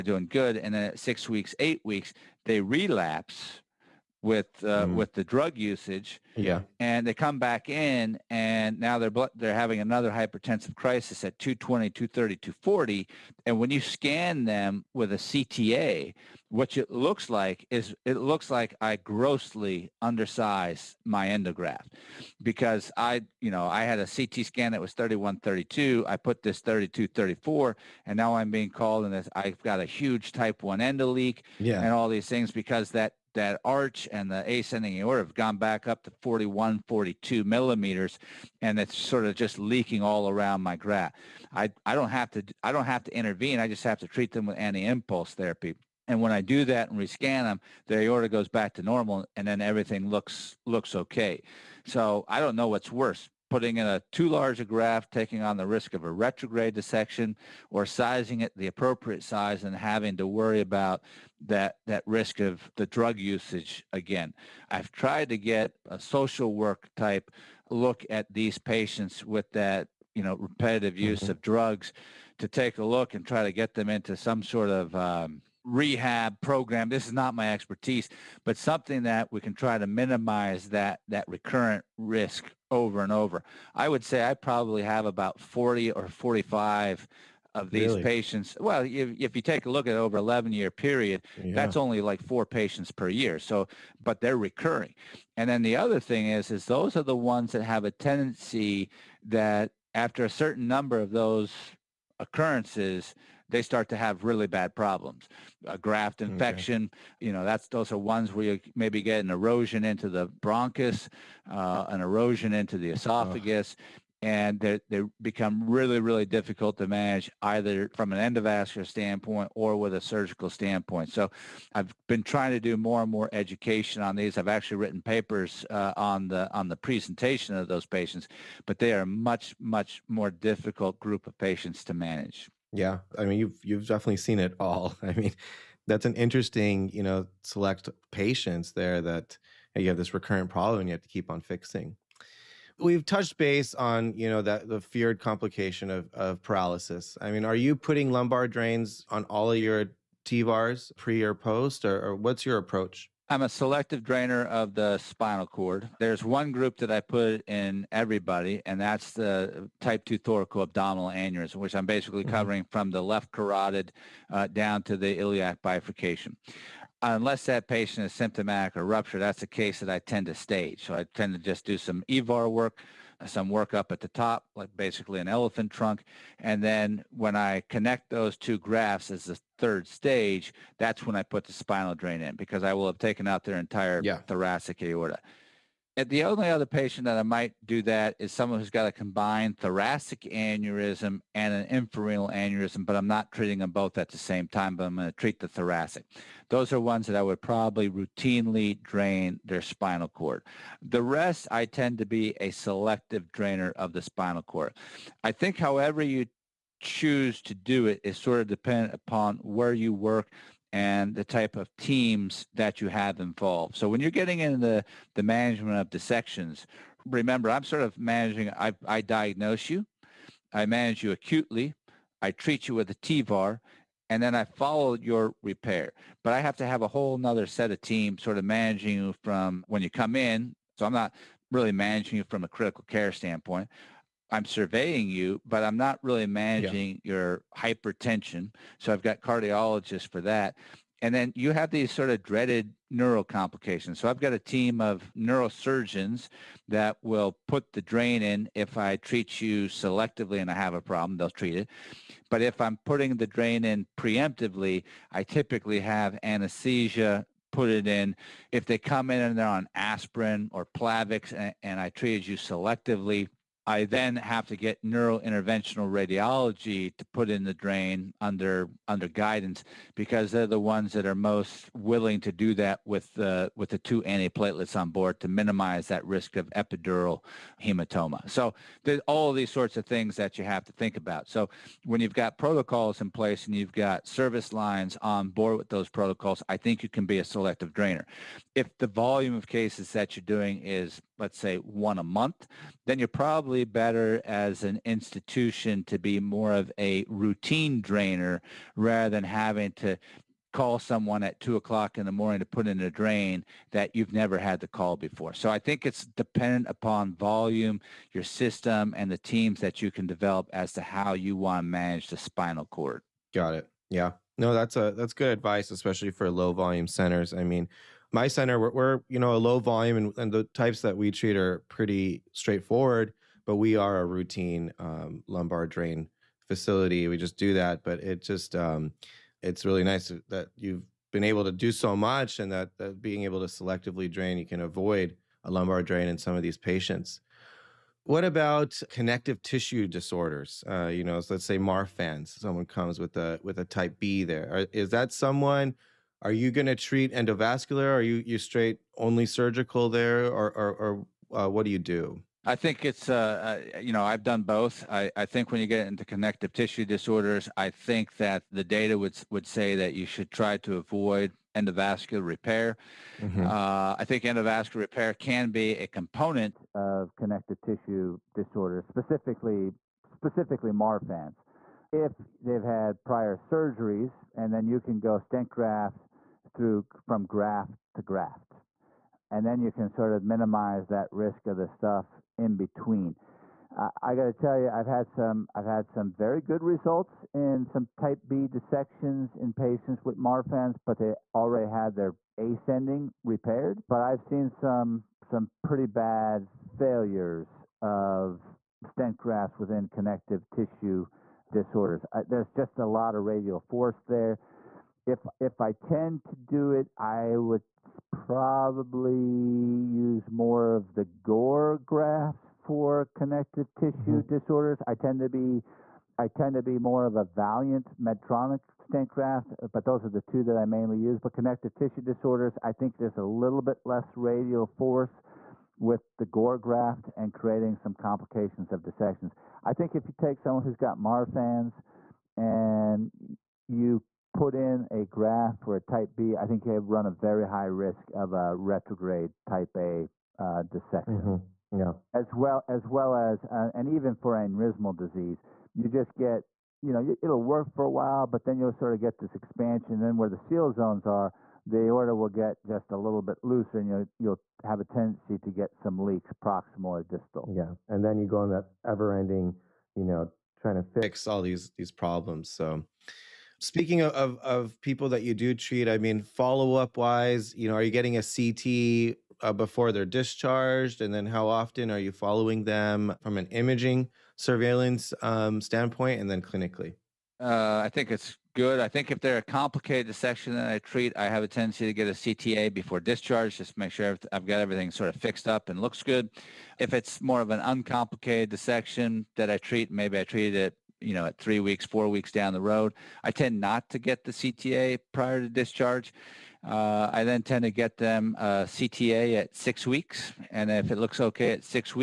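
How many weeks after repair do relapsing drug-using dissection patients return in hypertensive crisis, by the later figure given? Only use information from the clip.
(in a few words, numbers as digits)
8 weeks.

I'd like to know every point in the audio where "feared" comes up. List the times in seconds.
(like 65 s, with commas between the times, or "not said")
144 s.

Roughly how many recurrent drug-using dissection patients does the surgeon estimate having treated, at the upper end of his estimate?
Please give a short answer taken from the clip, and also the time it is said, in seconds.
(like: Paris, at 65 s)
45, at 86 s.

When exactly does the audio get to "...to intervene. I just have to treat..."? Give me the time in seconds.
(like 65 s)
43 s.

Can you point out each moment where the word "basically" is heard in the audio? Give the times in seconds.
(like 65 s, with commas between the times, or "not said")
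161 s, 174 s.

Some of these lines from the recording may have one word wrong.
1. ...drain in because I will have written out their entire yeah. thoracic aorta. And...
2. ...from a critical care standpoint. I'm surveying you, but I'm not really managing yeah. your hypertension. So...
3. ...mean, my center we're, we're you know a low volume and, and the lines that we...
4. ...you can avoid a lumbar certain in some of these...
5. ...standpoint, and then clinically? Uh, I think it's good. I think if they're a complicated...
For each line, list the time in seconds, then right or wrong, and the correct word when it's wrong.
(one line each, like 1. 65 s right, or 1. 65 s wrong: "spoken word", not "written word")
1. 181 s wrong: "taken", not "written"
2. 232 s right
3. 317 s wrong: "types", not "lines"
4. 334 s wrong: "drain", not "certain"
5. 475 s right.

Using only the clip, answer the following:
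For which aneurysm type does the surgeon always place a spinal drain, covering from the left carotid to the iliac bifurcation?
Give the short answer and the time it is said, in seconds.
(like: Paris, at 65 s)
type 2 thoracoabdominal, at 159 s.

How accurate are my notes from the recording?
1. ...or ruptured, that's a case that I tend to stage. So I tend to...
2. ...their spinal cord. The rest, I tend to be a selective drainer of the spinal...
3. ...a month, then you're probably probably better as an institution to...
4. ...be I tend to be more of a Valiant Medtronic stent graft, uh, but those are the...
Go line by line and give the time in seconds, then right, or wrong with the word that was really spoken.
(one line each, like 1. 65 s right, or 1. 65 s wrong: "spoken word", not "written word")
1. 168 s right
2. 199 s right
3. 291 s right
4. 415 s right.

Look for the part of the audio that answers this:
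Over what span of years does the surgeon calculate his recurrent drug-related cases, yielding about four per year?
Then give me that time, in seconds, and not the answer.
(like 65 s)
90 s.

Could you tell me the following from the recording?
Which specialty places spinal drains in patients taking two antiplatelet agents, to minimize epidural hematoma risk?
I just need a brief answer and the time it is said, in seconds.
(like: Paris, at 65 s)
neurointerventional radiology, at 264 s.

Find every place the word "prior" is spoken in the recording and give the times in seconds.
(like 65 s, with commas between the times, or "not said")
373 s, 495 s.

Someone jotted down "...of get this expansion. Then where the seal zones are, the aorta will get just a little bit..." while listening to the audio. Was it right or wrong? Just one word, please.
right.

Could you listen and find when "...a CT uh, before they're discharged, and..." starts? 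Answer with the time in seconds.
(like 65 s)
468 s.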